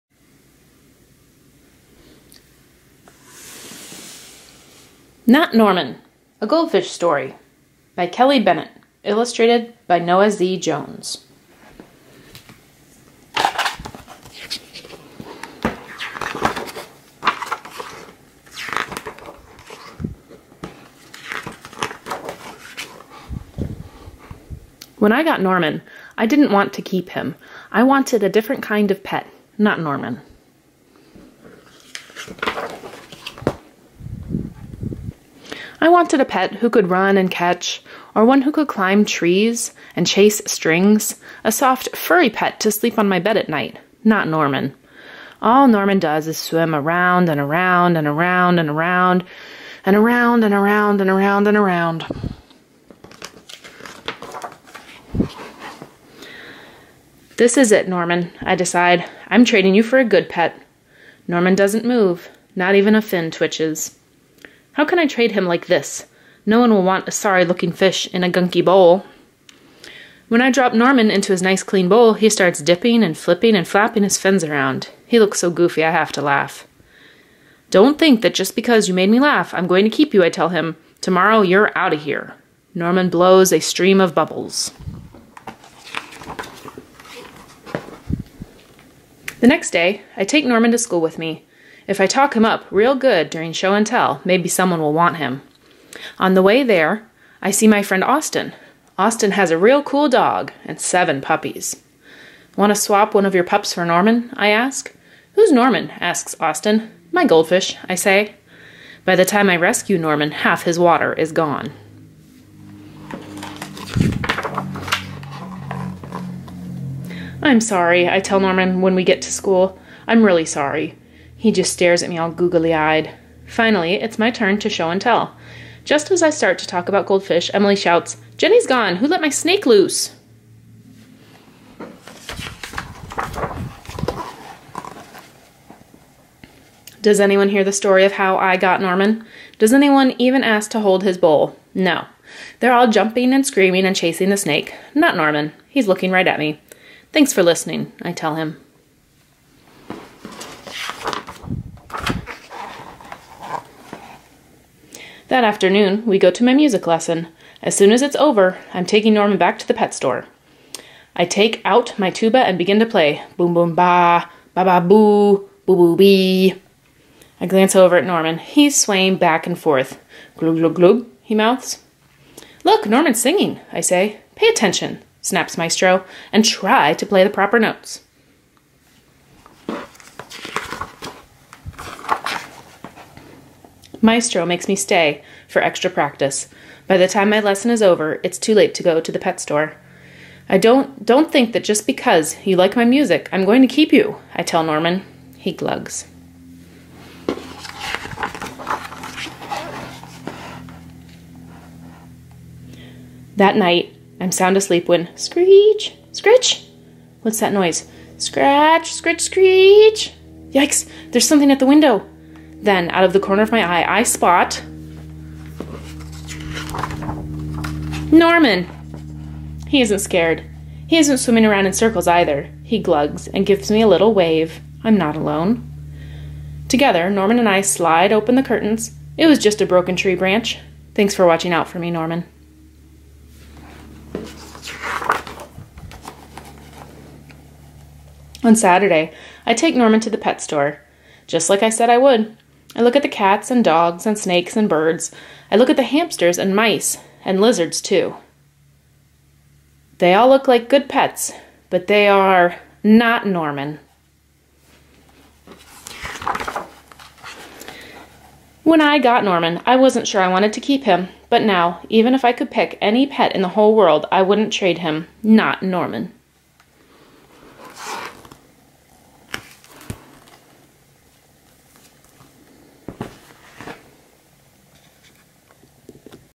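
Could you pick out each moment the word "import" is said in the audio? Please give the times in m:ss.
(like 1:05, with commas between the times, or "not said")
not said.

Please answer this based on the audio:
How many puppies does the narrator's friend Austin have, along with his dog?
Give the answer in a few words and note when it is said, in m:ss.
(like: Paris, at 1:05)
7, at 1:40.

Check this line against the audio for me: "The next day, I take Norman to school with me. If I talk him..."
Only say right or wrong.
right.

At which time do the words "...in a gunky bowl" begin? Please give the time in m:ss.
1:08.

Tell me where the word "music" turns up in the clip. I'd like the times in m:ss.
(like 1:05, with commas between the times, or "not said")
2:36, 3:12.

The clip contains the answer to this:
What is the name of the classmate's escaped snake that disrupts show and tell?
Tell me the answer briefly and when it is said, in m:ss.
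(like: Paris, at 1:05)
Jenny, at 2:08.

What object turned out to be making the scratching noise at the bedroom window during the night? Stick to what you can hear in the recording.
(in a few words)
A broken tree branch.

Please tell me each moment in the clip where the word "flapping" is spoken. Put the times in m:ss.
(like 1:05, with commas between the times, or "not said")
1:13.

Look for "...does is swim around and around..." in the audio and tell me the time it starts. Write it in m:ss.
0:45.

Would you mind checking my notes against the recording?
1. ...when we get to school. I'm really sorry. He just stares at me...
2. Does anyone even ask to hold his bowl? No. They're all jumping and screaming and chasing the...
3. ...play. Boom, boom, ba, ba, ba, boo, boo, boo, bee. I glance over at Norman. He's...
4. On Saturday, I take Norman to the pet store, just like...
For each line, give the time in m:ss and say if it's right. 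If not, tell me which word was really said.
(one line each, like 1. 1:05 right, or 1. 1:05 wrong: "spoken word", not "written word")
1. 1:58 right
2. 2:19 right
3. 2:42 right
4. 3:58 right.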